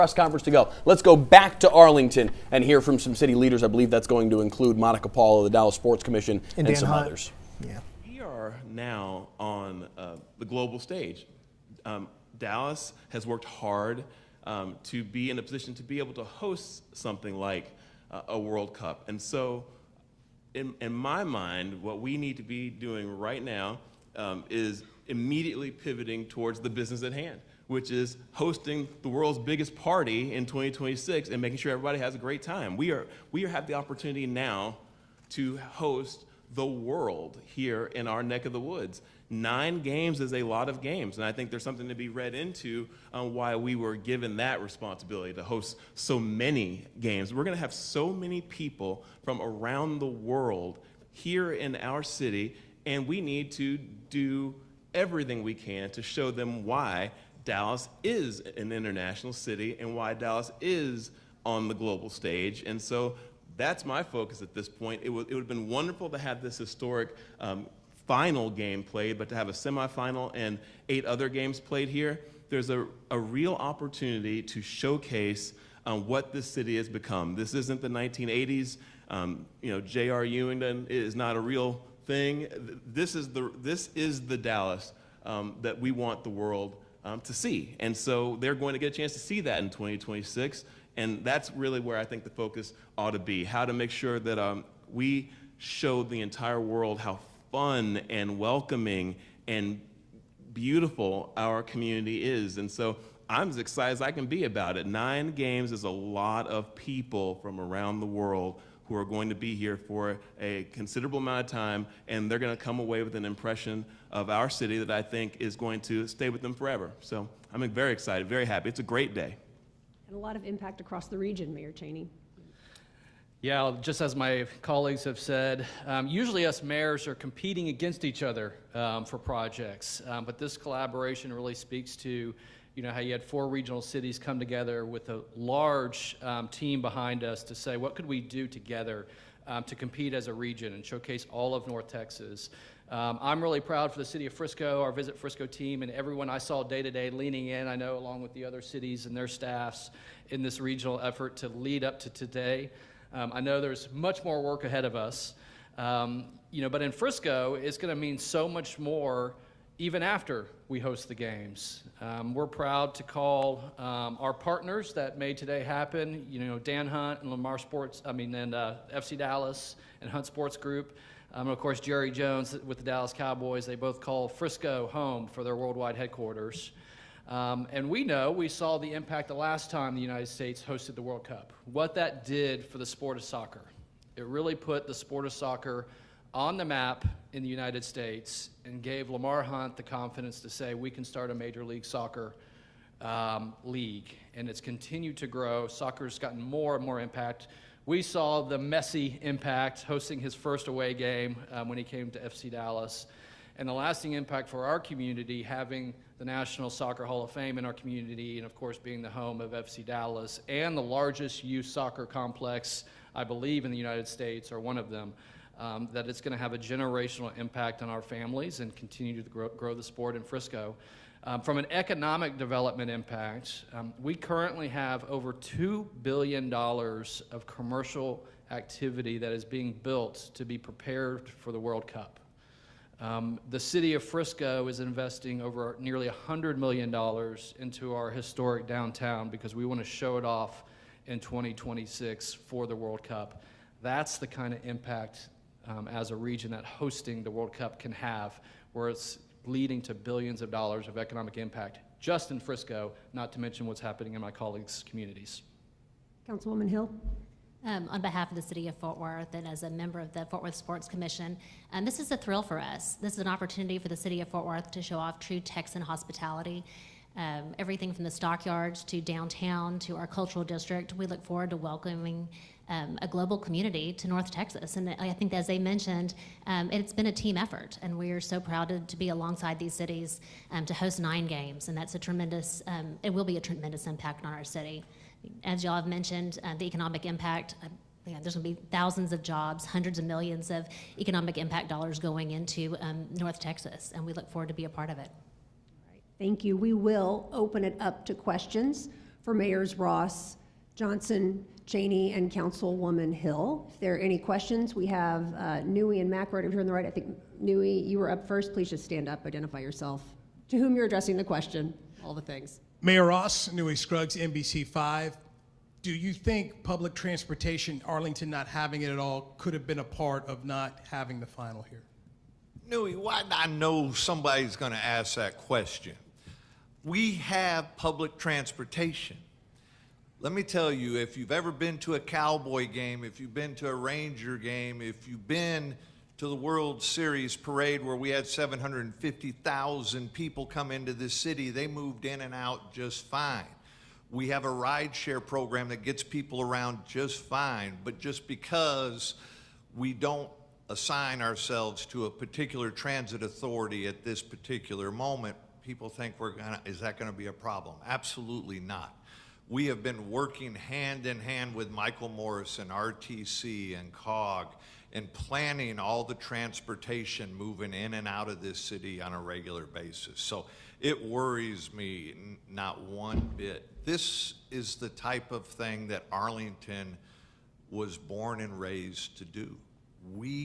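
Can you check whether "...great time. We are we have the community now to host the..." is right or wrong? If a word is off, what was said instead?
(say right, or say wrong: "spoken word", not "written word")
wrong: "opportunity", not "community".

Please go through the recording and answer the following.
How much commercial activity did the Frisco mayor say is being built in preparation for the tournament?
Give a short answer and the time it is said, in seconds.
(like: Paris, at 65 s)
Over $2 billion, at 225 s.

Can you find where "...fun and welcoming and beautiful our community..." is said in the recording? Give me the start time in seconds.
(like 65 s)
97 s.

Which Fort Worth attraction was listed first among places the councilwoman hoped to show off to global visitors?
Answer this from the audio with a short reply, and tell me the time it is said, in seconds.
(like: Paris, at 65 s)
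The stockyards, at 268 s.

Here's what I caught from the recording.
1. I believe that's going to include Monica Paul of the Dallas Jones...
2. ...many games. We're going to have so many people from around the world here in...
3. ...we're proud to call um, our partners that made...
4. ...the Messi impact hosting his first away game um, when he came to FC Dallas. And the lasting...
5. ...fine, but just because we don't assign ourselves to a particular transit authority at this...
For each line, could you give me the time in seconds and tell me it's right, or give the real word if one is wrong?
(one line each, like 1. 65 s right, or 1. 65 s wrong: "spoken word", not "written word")
1. 3 s wrong: "Sports", not "Jones"
2. 46 s right
3. 162 s right
4. 198 s right
5. 347 s right.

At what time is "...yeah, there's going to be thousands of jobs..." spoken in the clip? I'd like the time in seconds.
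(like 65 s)
288 s.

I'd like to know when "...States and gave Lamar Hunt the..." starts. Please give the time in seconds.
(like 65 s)
187 s.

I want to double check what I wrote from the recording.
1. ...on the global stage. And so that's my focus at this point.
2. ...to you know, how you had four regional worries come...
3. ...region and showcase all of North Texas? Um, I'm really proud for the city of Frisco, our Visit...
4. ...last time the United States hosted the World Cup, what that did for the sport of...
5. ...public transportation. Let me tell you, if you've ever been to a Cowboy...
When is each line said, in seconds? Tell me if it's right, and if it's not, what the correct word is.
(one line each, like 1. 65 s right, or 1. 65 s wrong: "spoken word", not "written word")
1. 61 s right
2. 131 s wrong: "cities", not "worries"
3. 140 s right
4. 179 s right
5. 327 s right.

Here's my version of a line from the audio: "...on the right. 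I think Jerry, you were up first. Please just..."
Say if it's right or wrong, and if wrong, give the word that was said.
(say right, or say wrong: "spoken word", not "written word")
wrong: "Nui", not "Jerry".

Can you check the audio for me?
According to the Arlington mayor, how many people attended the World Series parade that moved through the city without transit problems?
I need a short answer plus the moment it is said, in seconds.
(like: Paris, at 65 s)
750,000, at 338 s.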